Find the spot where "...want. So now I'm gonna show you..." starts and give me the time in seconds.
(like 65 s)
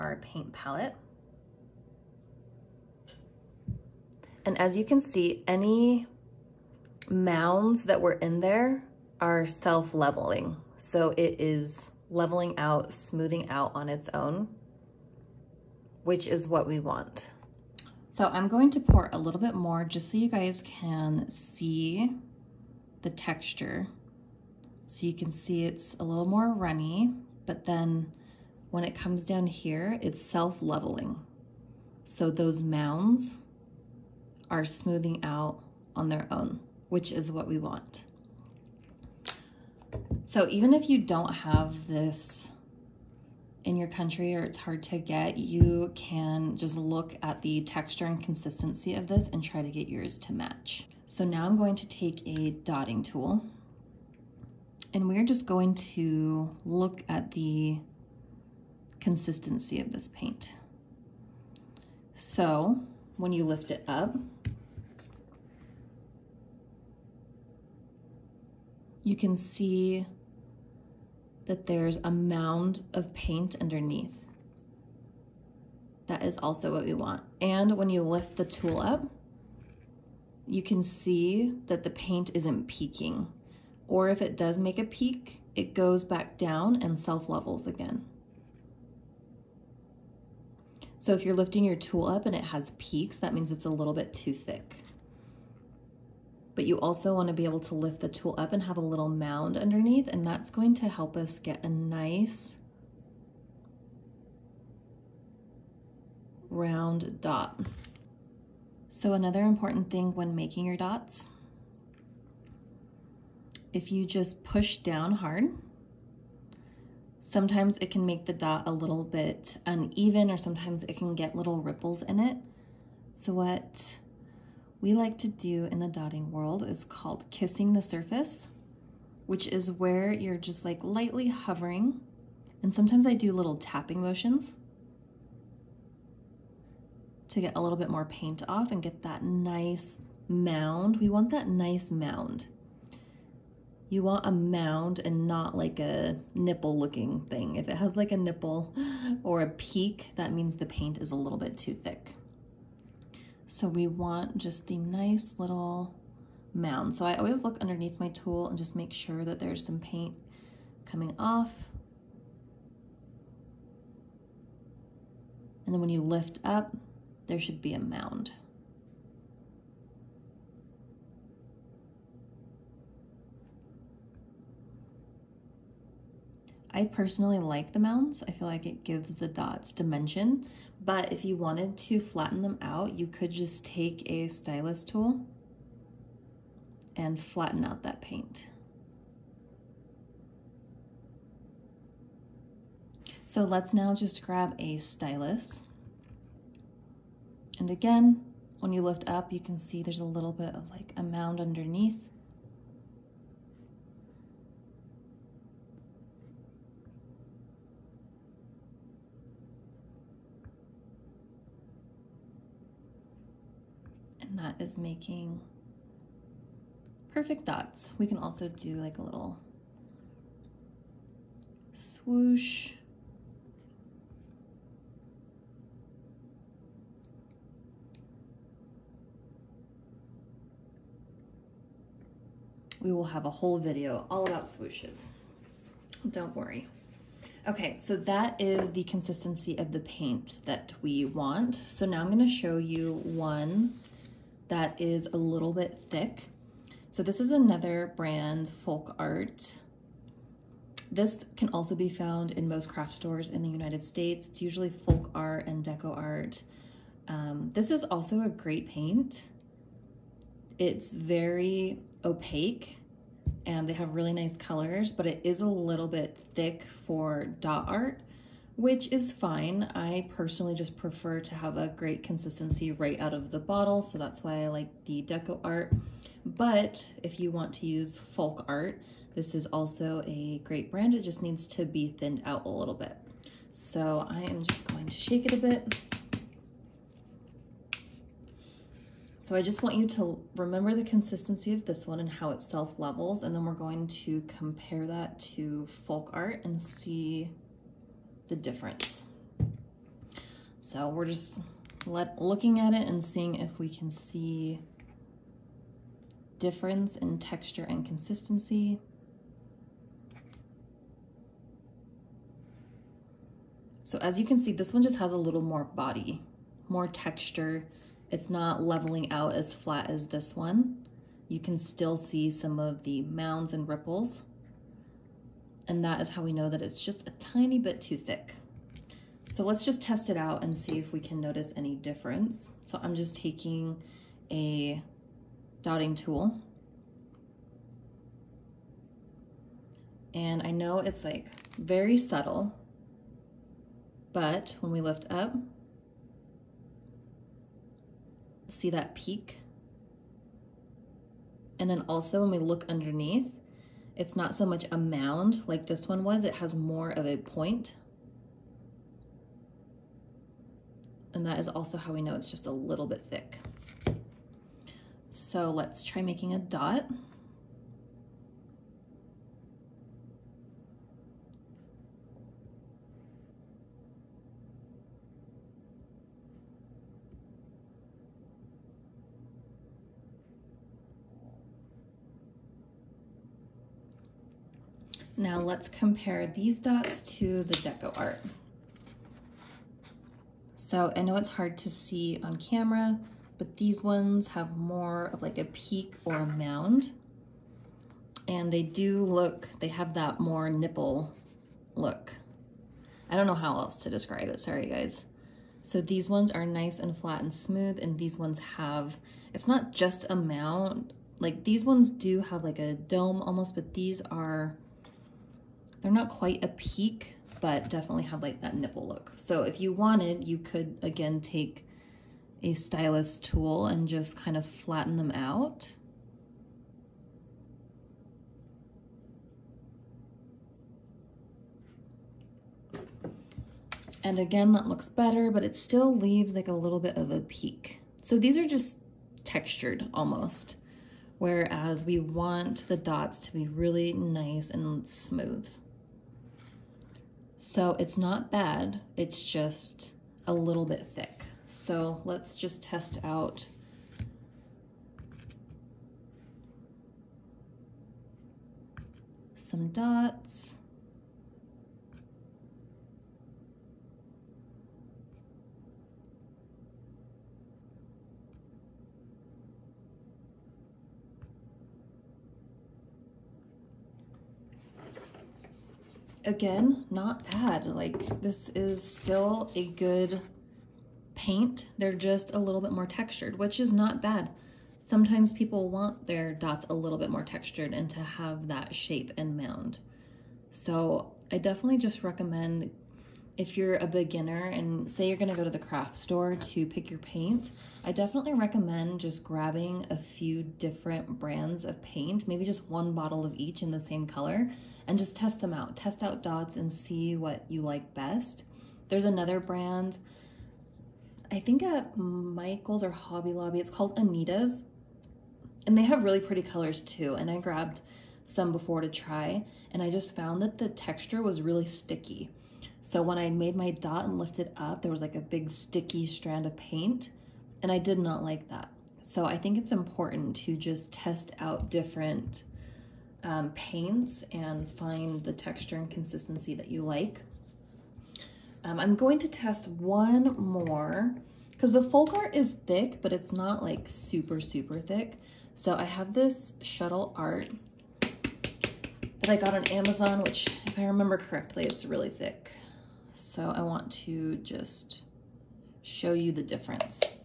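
241 s.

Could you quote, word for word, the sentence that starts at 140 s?
We want that nice mound you want a mound and not like a nipple looking thing.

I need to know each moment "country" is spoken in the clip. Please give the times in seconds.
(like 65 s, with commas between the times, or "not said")
43 s.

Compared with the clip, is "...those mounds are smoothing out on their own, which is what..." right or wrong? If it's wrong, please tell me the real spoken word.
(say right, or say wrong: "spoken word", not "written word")
right.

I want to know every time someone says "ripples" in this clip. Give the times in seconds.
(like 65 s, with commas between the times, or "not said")
121 s, 323 s.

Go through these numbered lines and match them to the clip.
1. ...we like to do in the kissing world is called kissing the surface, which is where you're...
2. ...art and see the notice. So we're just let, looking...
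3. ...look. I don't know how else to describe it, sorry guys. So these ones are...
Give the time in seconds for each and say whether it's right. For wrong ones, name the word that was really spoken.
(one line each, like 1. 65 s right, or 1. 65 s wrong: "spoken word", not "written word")
1. 124 s wrong: "dotting", not "kissing"
2. 296 s wrong: "difference", not "notice"
3. 401 s right.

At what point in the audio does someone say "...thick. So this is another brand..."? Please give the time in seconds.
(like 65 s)
245 s.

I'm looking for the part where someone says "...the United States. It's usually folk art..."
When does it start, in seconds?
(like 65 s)
253 s.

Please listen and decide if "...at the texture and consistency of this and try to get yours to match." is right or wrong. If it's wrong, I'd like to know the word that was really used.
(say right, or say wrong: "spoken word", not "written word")
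right.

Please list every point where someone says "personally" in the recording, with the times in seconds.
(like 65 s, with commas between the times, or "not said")
176 s, 270 s.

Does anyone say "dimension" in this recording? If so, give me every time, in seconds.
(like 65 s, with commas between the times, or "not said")
179 s.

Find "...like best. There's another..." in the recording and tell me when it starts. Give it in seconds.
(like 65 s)
507 s.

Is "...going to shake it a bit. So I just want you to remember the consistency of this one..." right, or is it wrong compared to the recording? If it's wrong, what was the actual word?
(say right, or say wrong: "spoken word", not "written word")
right.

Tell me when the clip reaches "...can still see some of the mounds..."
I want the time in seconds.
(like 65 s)
321 s.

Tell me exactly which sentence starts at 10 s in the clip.
So it is leveling out, smoothing out on its own, which is what we want.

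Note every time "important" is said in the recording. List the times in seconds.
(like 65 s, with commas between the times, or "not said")
109 s, 529 s.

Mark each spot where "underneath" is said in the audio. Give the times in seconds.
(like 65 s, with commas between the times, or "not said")
73 s, 99 s, 157 s, 201 s, 352 s.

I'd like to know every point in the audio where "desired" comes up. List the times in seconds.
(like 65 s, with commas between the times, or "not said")
not said.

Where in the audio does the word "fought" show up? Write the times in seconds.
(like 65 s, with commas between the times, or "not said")
not said.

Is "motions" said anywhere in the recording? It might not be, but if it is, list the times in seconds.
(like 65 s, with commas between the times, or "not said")
134 s.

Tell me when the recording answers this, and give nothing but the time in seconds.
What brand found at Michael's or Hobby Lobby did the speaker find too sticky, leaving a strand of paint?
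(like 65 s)
513 s.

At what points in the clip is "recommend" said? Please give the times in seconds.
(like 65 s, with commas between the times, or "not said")
492 s, 498 s.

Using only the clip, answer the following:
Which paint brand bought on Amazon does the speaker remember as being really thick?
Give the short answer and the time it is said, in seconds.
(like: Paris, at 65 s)
Shuttle Art, at 546 s.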